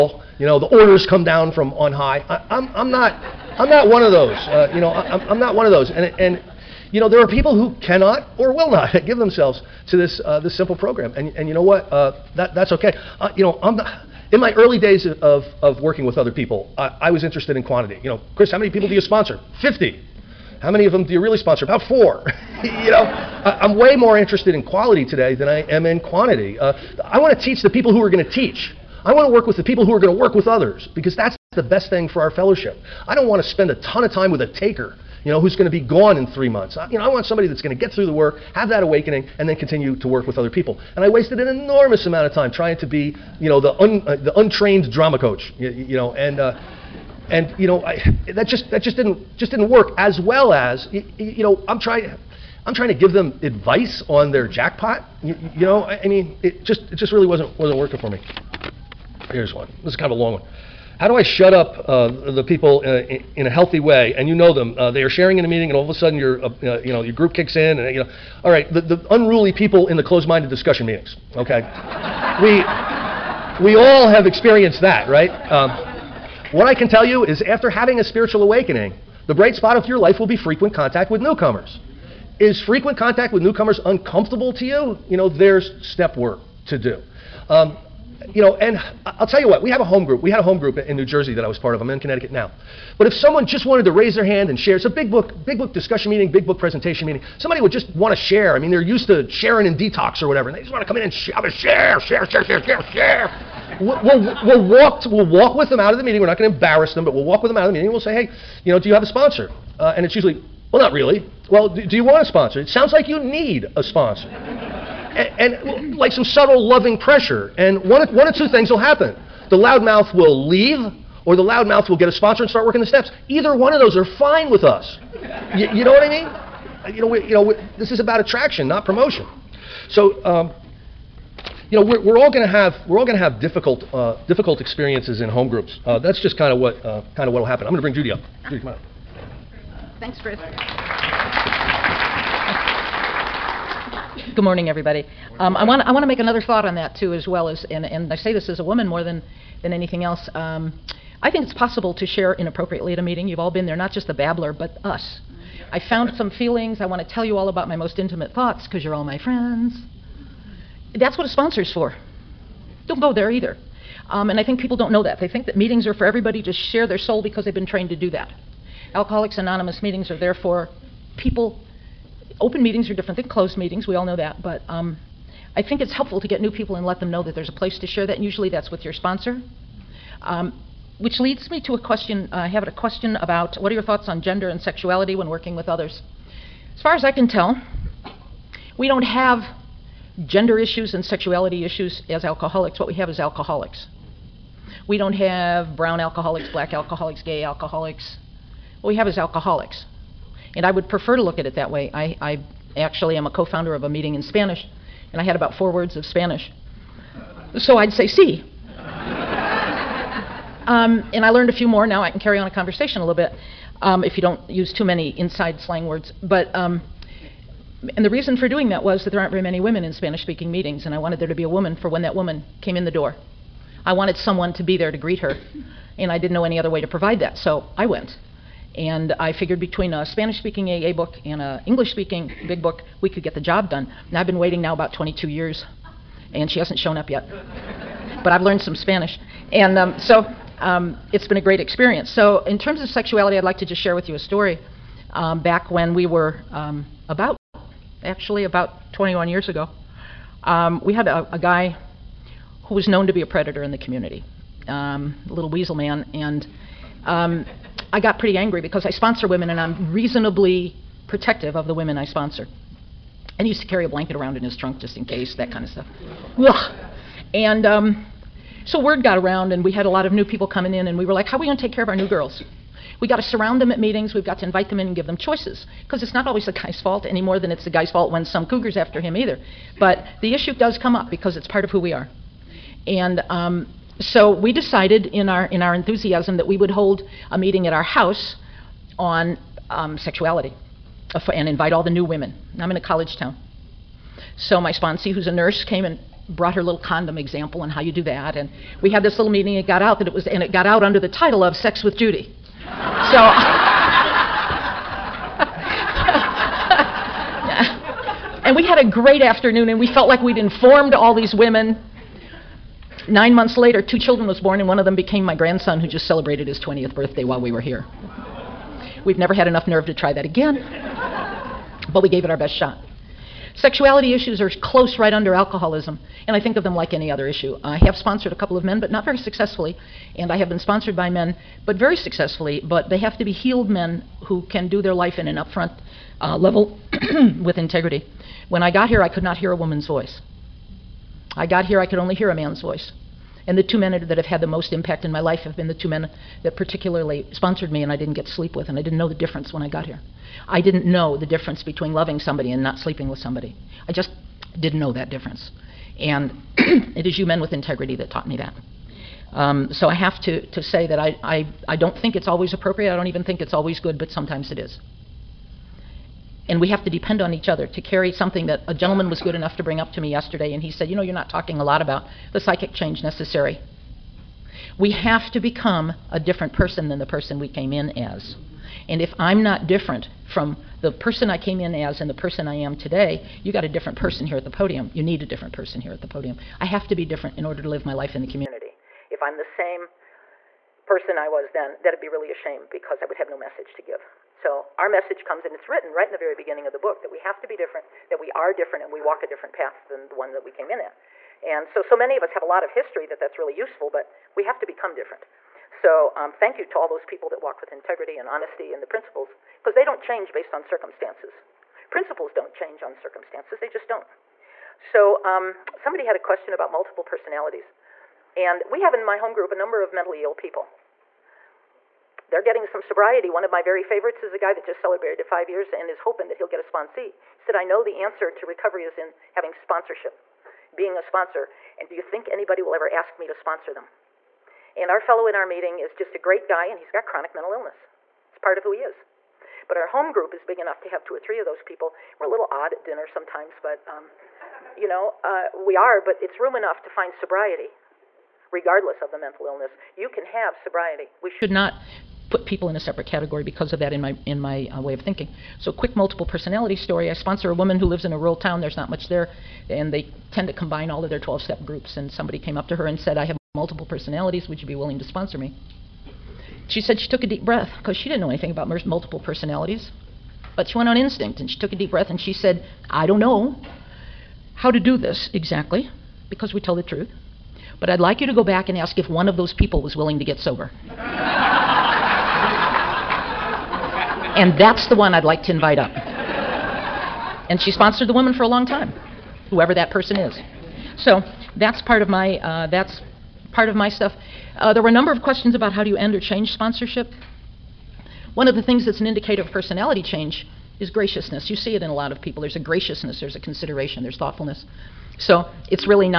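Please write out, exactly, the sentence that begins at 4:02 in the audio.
So, in terms of sexuality, I'd like to just share with you a story.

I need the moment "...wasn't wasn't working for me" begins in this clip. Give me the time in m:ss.
0:57.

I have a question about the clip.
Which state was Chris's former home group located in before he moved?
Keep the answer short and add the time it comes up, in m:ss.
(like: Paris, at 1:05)
New Jersey, at 1:30.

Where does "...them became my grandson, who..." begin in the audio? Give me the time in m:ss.
5:14.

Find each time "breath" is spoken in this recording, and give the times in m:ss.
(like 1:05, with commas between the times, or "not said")
7:47, 7:51.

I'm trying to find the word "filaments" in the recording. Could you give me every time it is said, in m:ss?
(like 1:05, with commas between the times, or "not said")
not said.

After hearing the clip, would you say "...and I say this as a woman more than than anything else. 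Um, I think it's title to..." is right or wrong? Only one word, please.
wrong.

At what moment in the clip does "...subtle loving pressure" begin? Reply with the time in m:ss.
1:56.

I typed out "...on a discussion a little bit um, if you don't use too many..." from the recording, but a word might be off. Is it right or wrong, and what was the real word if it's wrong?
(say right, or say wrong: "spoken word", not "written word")
wrong: "conversation", not "discussion".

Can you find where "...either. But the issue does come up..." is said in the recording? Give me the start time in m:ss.
4:39.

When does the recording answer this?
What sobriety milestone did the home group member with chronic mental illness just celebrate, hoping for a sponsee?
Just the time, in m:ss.
7:05.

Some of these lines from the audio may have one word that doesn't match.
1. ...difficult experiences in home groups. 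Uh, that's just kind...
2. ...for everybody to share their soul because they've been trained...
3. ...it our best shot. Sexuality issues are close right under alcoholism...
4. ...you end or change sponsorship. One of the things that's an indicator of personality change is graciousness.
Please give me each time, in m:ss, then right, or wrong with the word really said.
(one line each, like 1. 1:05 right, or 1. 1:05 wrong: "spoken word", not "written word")
1. 2:14 right
2. 2:45 right
3. 5:22 right
4. 8:15 right.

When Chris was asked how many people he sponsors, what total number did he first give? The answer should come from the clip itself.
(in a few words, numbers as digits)
50.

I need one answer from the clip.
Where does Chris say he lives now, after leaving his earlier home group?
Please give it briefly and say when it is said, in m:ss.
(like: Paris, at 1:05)
Connecticut, at 1:31.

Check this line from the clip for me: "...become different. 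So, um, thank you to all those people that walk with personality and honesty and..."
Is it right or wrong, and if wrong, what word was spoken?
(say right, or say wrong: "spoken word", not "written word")
wrong: "integrity", not "personality".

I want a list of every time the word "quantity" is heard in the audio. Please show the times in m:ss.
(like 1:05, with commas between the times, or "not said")
0:17, 0:26.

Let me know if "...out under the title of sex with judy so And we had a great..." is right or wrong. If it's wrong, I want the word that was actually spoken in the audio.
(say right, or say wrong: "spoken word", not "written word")
right.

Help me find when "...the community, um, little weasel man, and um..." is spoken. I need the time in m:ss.
4:13.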